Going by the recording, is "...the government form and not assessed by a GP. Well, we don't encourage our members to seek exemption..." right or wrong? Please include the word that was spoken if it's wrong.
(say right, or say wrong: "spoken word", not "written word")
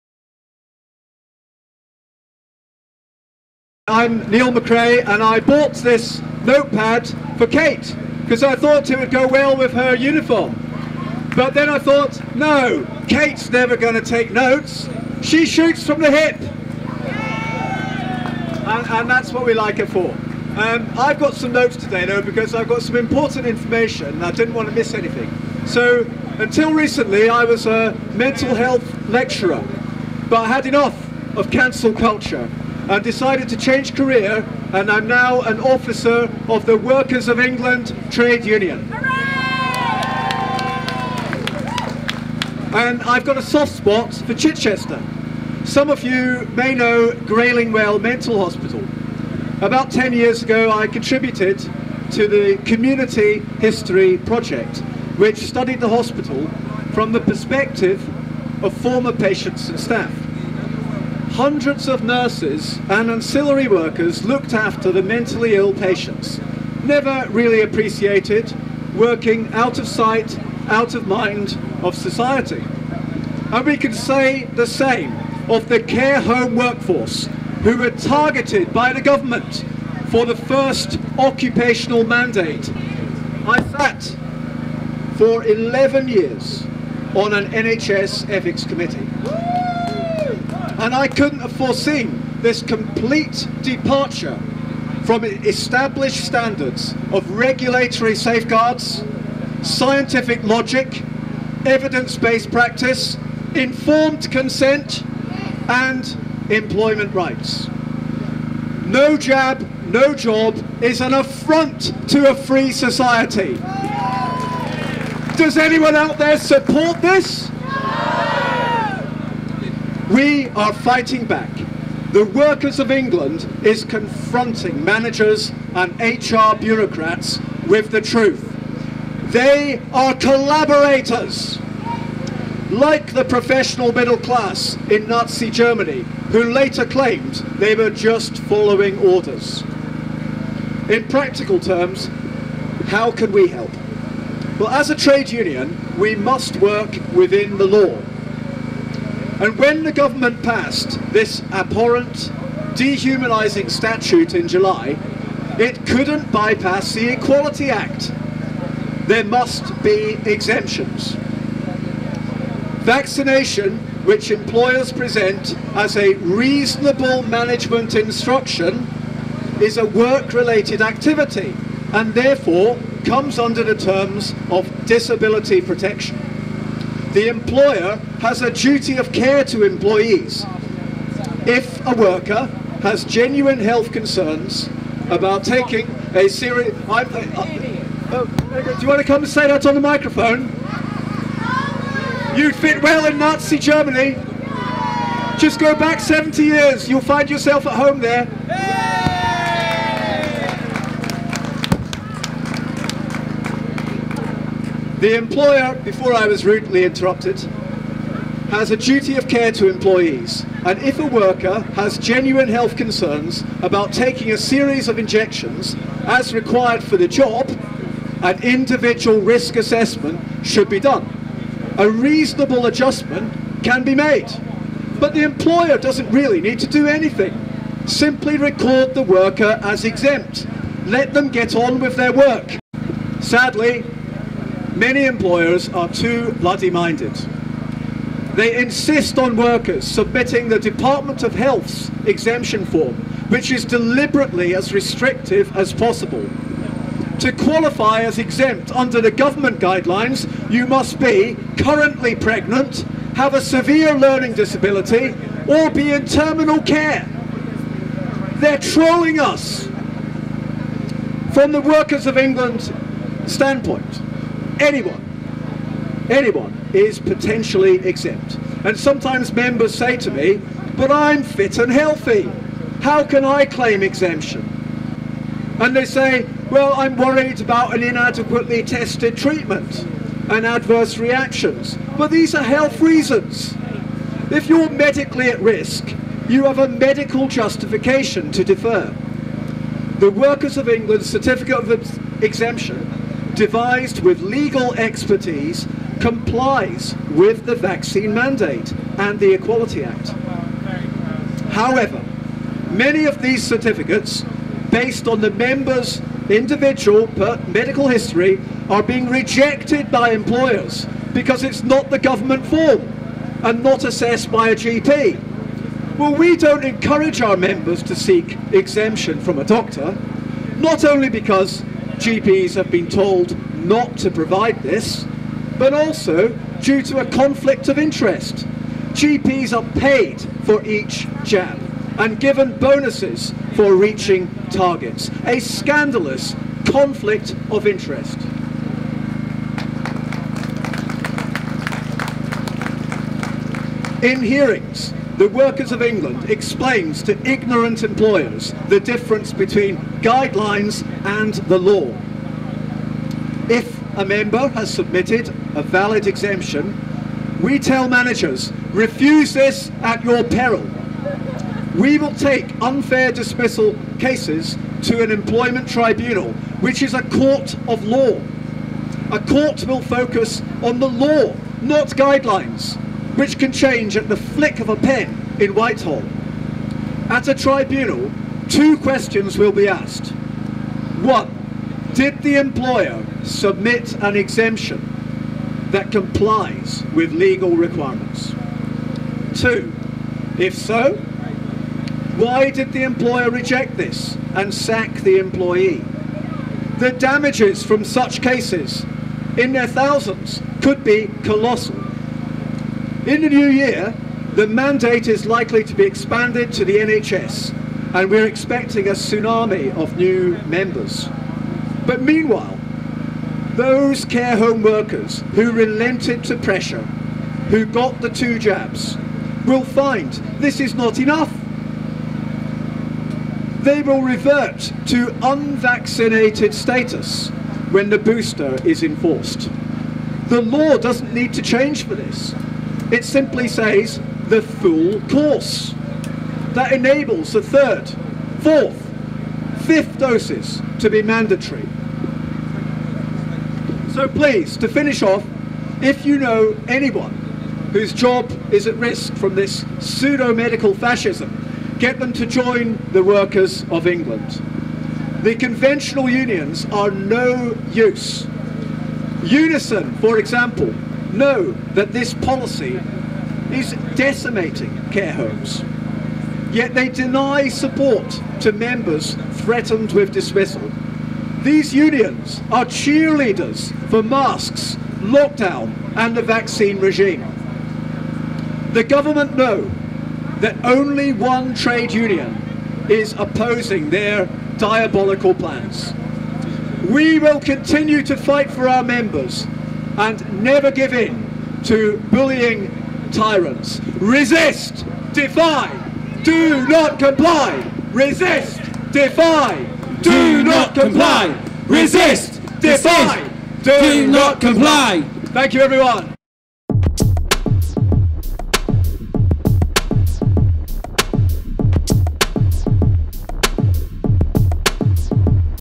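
right.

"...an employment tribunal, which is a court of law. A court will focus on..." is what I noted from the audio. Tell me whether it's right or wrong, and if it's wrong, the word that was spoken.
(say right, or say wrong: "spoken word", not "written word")
right.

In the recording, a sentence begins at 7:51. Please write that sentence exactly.
These unions are cheerleaders for masks, lockdown and the vaccine regime.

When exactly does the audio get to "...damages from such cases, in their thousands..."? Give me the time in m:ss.
6:36.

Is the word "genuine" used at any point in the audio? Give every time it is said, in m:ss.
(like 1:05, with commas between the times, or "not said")
3:03, 3:31.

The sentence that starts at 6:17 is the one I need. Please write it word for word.
At a tribunal, two questions will be asked.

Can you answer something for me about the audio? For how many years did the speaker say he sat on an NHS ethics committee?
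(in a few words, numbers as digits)
11.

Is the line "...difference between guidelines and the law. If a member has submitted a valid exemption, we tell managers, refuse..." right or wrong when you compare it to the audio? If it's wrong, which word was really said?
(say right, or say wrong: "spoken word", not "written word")
right.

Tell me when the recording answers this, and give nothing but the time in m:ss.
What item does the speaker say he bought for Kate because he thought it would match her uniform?
0:06.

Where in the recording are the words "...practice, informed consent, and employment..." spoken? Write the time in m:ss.
1:42.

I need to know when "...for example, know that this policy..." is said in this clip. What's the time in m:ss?
7:39.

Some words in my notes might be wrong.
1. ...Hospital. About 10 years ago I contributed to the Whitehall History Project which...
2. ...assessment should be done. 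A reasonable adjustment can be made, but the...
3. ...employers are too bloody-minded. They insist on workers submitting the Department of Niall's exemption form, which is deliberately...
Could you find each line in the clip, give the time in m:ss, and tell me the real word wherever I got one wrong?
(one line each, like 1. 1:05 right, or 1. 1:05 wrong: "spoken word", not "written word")
1. 0:48 wrong: "Community", not "Whitehall"
2. 3:39 right
3. 3:55 wrong: "Health", not "Niall".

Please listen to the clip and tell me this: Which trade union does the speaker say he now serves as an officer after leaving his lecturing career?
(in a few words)
Workers of England Trade Union.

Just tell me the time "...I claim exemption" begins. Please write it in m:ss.
4:33.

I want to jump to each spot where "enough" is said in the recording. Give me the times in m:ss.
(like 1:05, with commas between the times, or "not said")
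0:30, 7:00.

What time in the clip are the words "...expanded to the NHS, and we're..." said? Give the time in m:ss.
6:45.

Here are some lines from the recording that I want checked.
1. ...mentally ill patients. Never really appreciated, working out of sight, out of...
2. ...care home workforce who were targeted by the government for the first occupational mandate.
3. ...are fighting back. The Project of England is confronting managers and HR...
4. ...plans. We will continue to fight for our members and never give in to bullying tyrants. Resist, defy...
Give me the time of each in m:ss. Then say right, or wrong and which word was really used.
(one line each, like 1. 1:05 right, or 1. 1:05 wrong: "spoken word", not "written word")
1. 1:05 right
2. 1:15 right
3. 2:00 wrong: "Workers", not "Project"
4. 8:05 right.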